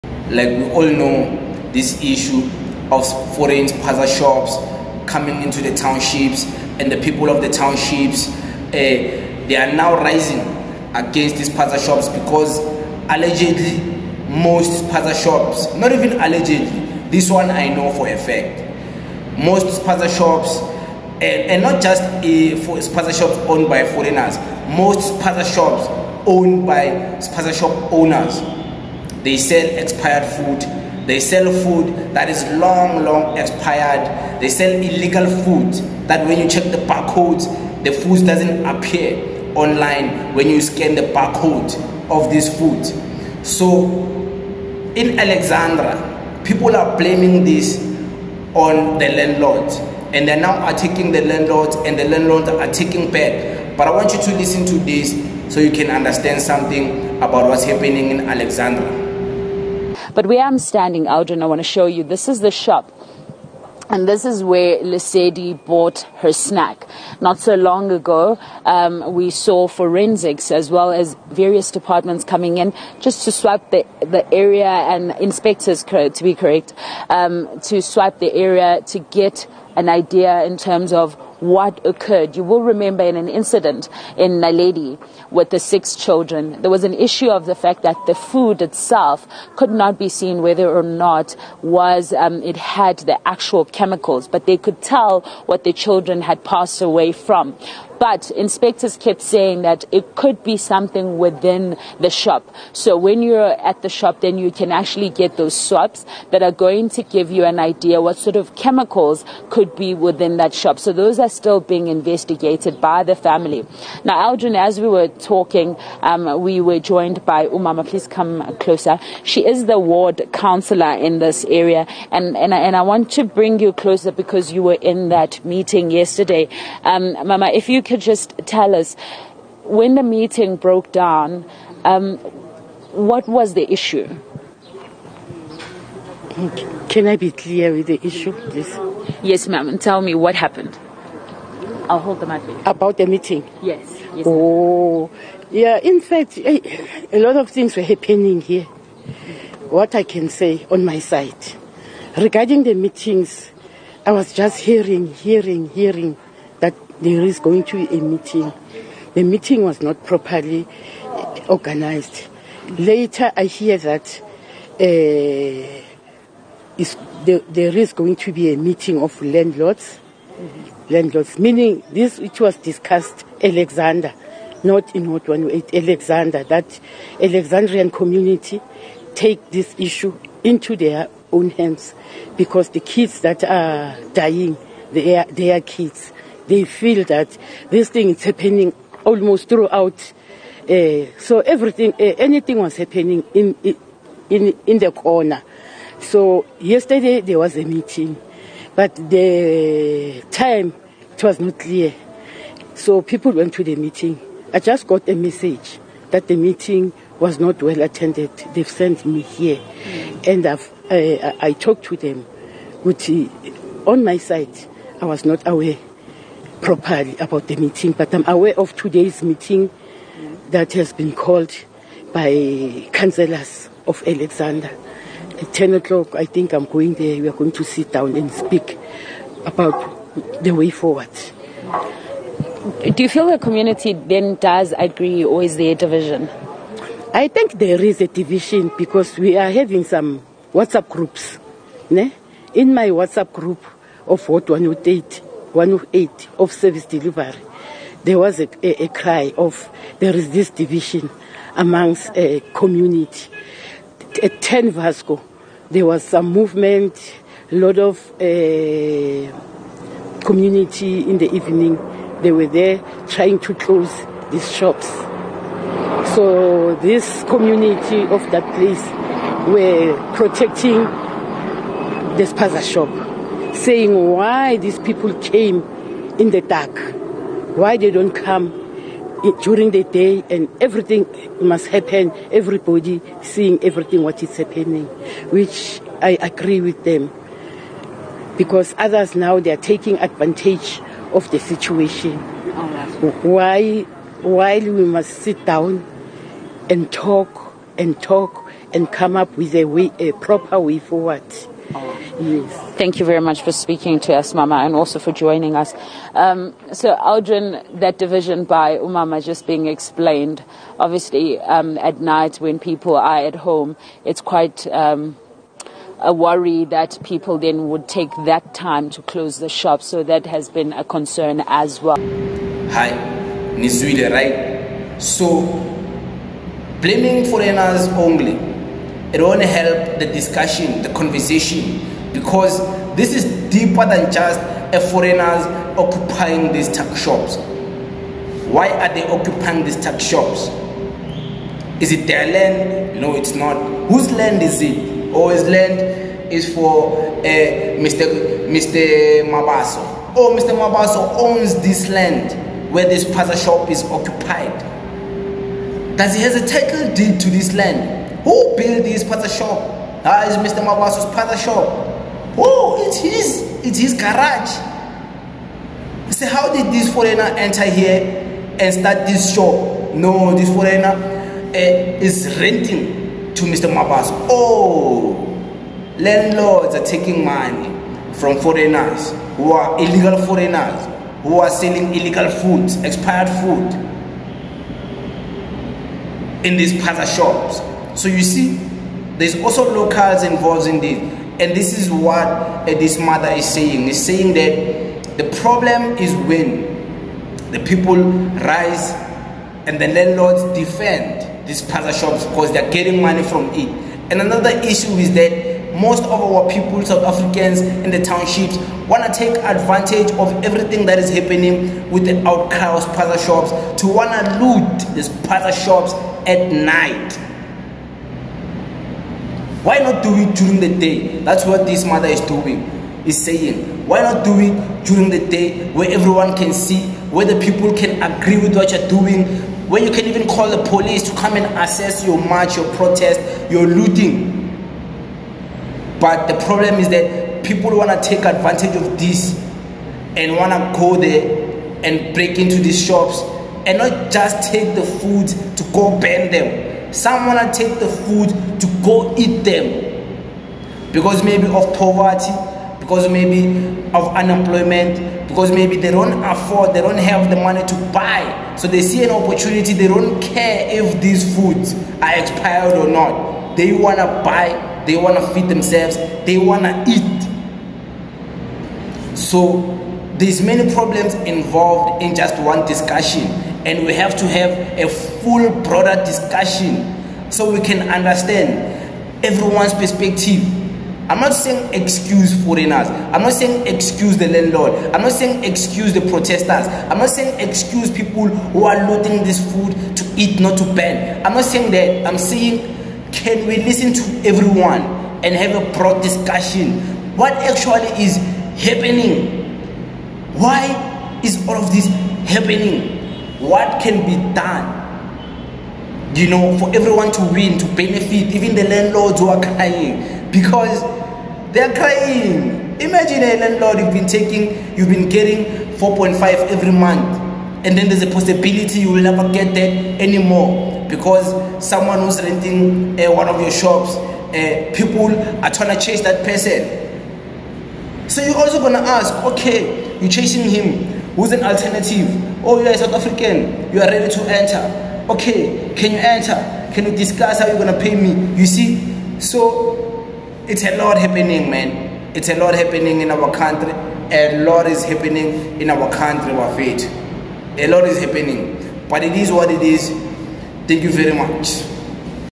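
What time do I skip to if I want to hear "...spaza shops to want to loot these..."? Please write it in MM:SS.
06:52.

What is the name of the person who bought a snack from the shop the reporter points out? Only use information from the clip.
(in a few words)
Lesedi.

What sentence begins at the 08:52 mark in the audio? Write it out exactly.
Oh, you are a South African.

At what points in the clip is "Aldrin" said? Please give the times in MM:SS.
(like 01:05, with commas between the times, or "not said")
01:54, 05:06.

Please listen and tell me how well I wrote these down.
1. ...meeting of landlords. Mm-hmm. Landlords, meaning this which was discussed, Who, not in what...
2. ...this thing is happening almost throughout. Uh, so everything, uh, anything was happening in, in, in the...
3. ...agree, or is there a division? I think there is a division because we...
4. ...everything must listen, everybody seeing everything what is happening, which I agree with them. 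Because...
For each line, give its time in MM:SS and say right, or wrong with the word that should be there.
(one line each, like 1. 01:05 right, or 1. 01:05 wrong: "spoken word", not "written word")
1. 02:48 wrong: "Alexandra", not "Who"
2. 03:07 right
3. 03:54 right
4. 04:40 wrong: "happen", not "listen".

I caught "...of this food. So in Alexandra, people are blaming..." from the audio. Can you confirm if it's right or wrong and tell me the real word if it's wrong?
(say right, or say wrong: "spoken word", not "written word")
right.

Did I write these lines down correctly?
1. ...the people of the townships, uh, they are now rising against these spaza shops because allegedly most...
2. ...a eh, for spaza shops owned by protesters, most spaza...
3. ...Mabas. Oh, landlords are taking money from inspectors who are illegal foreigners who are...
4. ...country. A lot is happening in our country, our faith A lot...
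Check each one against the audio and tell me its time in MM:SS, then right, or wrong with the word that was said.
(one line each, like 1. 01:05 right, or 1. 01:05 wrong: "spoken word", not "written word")
1. 00:06 right
2. 00:22 wrong: "foreigners", not "protesters"
3. 06:13 wrong: "foreigners", not "inspectors"
4. 09:03 right.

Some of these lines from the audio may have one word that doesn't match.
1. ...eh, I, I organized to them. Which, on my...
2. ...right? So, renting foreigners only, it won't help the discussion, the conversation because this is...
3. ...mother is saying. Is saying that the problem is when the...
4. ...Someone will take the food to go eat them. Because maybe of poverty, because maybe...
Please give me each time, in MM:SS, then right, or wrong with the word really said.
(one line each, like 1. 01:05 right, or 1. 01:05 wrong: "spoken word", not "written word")
1. 03:30 wrong: "talked", not "organized"
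2. 05:24 wrong: "blaming", not "renting"
3. 06:32 right
4. 07:26 right.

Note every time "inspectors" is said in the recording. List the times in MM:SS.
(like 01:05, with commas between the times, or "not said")
01:15, 01:38.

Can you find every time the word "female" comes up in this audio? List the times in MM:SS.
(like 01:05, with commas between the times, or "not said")
not said.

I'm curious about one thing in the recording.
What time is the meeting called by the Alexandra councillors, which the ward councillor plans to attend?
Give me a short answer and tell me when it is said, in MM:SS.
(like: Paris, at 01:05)
10 o'clock, at 03:45.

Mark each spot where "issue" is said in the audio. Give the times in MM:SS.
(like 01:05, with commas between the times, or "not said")
00:02, 01:26, 02:13, 02:18, 02:59, 06:44.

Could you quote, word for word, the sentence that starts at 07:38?
So they see an opportunity, they don't care if these foods are expired or not.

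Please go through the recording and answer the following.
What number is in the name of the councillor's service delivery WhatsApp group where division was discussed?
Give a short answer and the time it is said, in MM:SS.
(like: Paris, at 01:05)
108, at 04:05.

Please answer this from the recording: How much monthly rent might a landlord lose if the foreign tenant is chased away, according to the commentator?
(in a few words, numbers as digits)
4.5.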